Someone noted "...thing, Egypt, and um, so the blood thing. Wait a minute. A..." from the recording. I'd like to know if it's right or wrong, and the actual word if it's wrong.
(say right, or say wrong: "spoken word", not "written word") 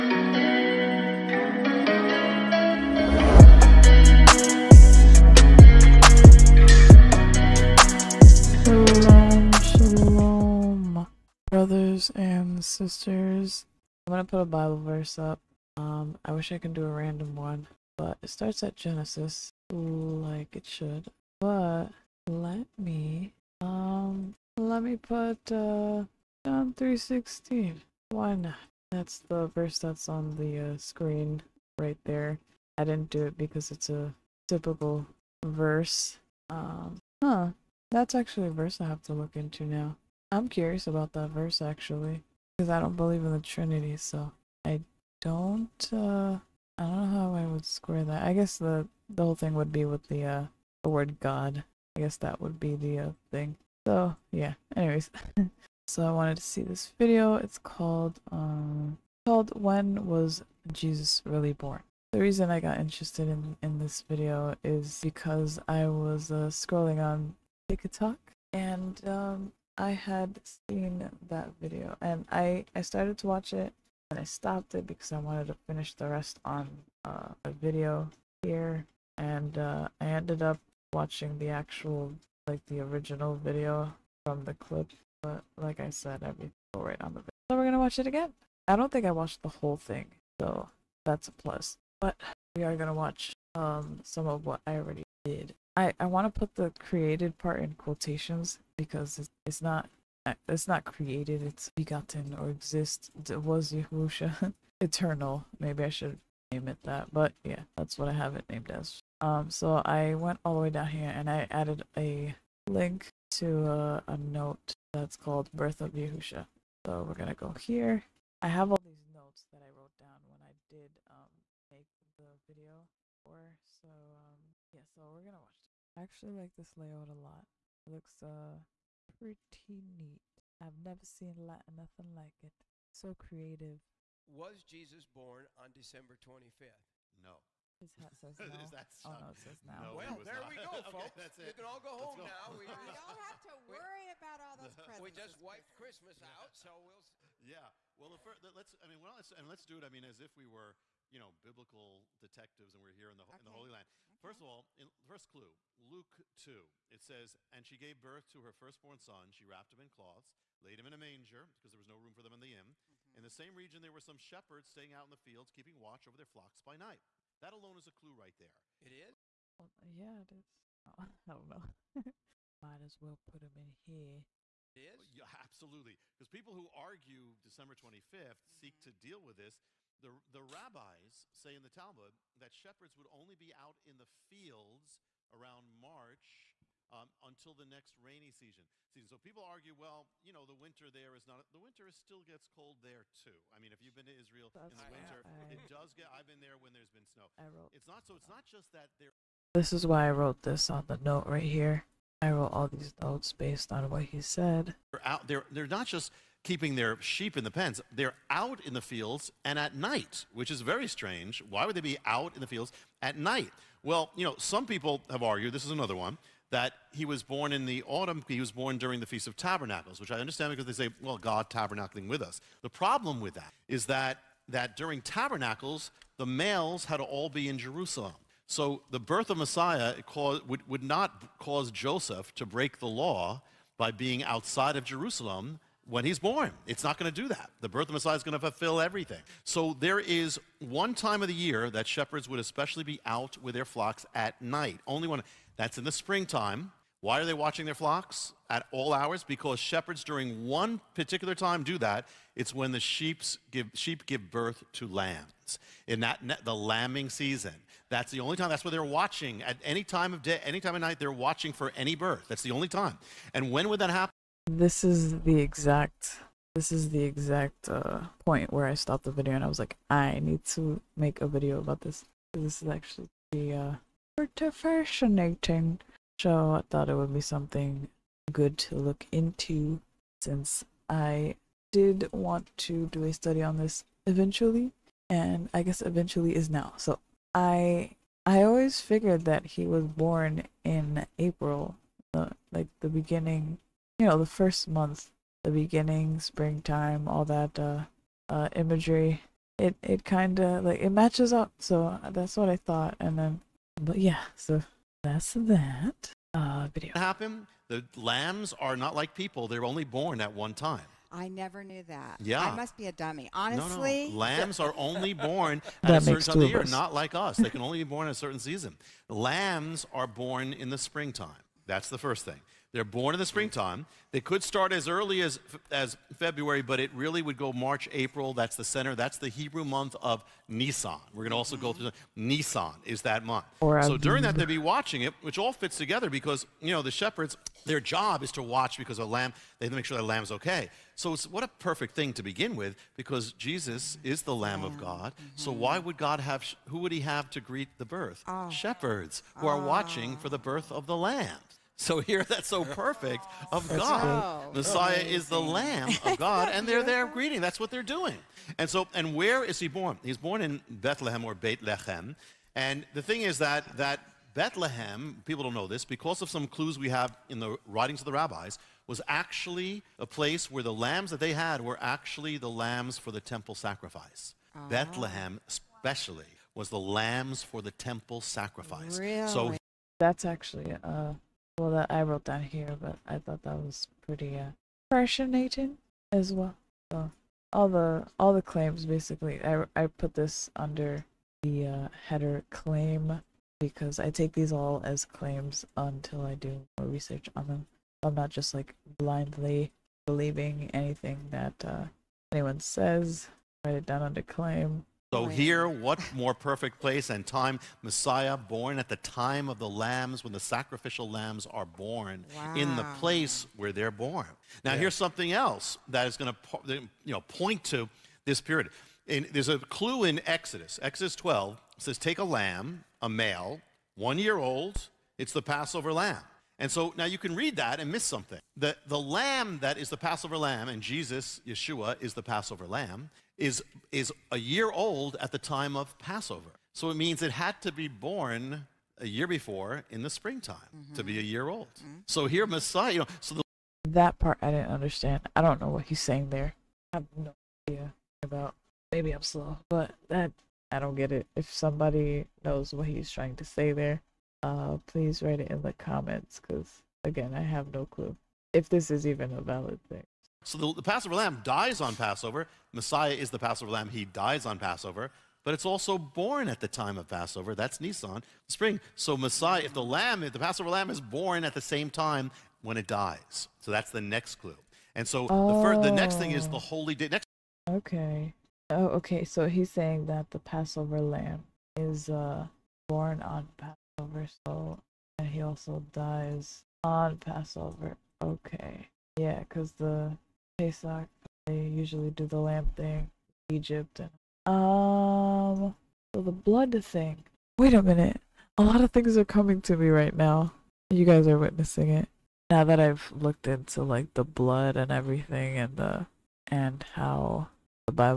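right.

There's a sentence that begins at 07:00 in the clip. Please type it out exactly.
Exodus 12 says, "Take a lamb, a male, one year old.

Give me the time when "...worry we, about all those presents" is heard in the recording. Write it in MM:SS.
02:23.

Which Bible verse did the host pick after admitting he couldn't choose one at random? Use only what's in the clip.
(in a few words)
John 3:16.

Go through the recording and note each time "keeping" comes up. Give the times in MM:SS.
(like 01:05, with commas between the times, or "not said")
02:45, 03:26.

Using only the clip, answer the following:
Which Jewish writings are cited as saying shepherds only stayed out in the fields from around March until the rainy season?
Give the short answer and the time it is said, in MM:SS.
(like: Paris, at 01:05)
The Talmud, at 03:01.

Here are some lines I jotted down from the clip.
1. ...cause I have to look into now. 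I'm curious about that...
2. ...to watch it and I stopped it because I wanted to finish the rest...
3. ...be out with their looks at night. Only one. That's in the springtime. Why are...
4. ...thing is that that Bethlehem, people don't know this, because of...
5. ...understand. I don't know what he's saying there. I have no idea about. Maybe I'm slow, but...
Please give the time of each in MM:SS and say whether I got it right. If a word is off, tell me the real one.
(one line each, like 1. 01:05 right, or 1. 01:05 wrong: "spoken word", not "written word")
1. 00:38 wrong: "verse", not "cause"
2. 01:13 right
3. 04:02 wrong: "flocks", not "looks"
4. 06:03 right
5. 07:24 right.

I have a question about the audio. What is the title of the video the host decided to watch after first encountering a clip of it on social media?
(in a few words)
When Was Jesus Really Born?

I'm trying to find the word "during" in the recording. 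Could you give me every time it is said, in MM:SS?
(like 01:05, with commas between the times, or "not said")
03:38, 03:44, 04:10, 05:33.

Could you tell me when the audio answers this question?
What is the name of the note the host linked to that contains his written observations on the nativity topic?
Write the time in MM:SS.
01:55.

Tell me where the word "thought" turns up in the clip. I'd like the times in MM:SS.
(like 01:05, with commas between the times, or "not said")
04:36, 05:02, 06:23.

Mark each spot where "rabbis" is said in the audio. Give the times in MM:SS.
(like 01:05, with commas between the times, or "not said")
03:00, 06:08.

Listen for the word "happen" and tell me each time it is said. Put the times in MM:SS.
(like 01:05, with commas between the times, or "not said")
04:23, 05:06.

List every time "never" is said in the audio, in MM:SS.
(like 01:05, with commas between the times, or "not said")
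02:10, 05:11.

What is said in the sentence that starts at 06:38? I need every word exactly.
I'm not just like blindly believing anything that uh, anyone says.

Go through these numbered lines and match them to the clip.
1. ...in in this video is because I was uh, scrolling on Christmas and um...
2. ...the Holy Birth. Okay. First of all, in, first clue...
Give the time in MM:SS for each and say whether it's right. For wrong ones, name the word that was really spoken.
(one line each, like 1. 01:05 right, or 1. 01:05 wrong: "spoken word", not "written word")
1. 01:03 wrong: "TikTok", not "Christmas"
2. 02:33 wrong: "Land", not "Birth".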